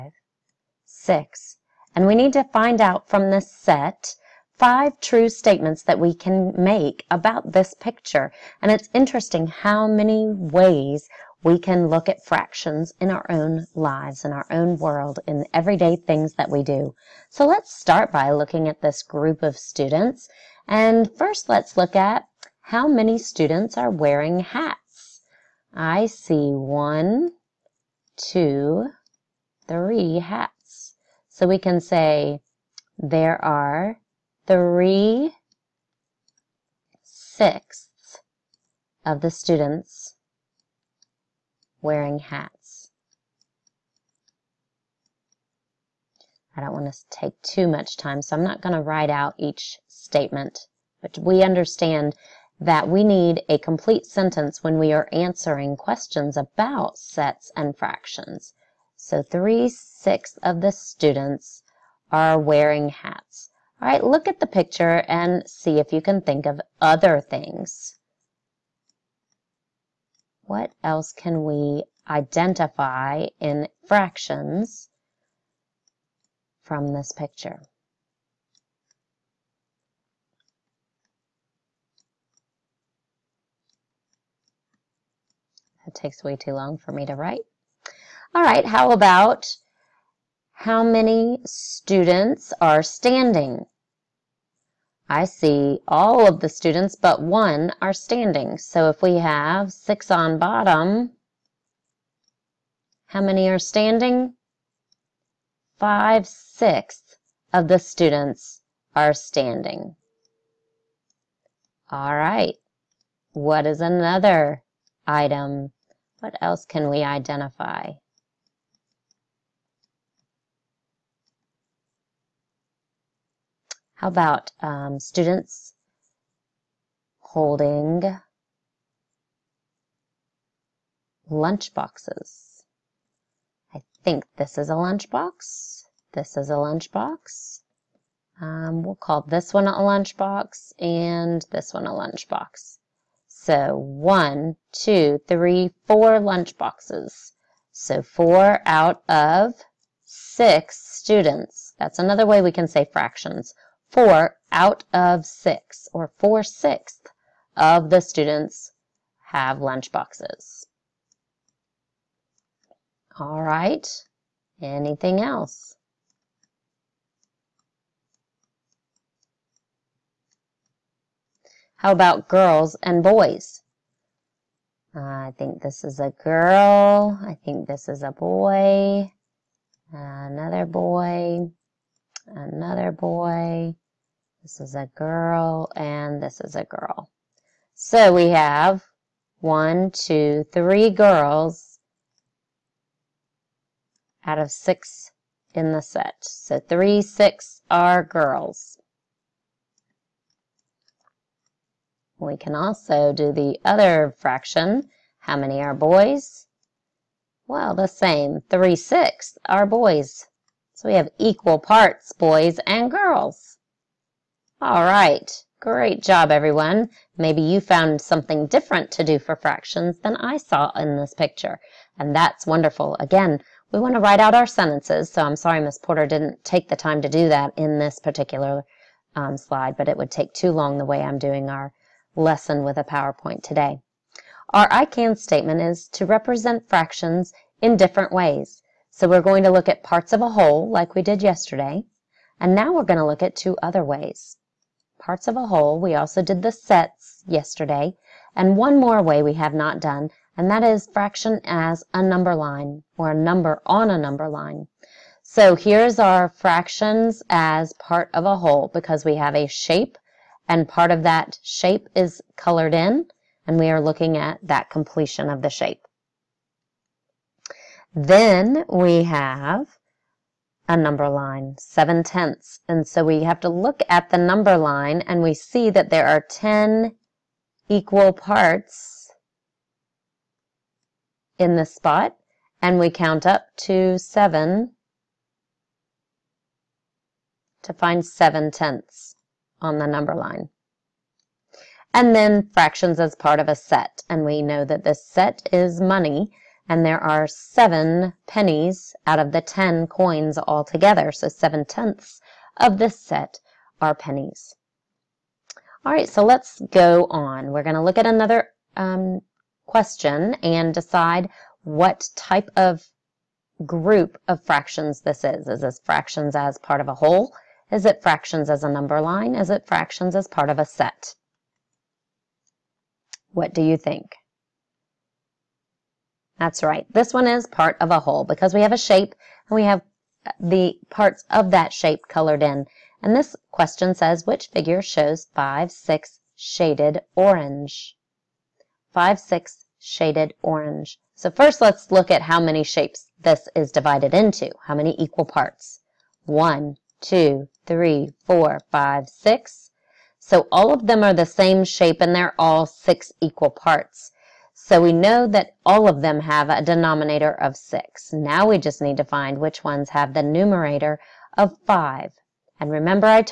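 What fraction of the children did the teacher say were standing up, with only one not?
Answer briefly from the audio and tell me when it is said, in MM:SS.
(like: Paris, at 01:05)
5/6, at 01:45.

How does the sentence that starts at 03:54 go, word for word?
Our I can statement is to represent fractions in different ways.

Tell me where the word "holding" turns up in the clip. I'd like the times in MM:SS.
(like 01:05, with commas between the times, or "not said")
02:07.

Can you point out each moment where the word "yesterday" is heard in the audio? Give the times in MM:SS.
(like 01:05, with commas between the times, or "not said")
04:01, 04:07.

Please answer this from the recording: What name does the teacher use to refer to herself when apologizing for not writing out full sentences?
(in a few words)
Miss Porter.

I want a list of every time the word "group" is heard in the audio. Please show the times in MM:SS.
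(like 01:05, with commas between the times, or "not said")
00:19, 05:13.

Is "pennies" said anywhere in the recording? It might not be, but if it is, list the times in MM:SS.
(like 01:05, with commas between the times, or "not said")
04:58, 05:03.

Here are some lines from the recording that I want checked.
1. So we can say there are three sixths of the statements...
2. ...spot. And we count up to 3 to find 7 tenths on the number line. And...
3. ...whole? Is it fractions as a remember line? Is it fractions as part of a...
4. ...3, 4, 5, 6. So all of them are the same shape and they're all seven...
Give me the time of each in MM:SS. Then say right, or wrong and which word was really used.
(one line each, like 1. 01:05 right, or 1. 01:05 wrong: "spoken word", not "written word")
1. 00:31 wrong: "students", not "statements"
2. 04:41 wrong: "7", not "3"
3. 05:16 wrong: "number", not "remember"
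4. 05:47 wrong: "six", not "seven".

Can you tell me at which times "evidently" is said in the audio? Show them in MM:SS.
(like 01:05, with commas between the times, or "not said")
not said.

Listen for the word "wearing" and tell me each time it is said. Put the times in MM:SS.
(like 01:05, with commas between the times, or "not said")
00:23, 00:41, 01:02.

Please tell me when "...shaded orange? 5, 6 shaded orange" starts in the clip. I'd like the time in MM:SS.
05:36.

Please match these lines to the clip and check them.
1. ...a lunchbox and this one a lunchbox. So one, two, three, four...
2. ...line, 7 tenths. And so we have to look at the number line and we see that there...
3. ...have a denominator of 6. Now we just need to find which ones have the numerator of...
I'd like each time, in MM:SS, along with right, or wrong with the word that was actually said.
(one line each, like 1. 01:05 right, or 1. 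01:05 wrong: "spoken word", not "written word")
1. 02:19 right
2. 04:31 right
3. 05:56 right.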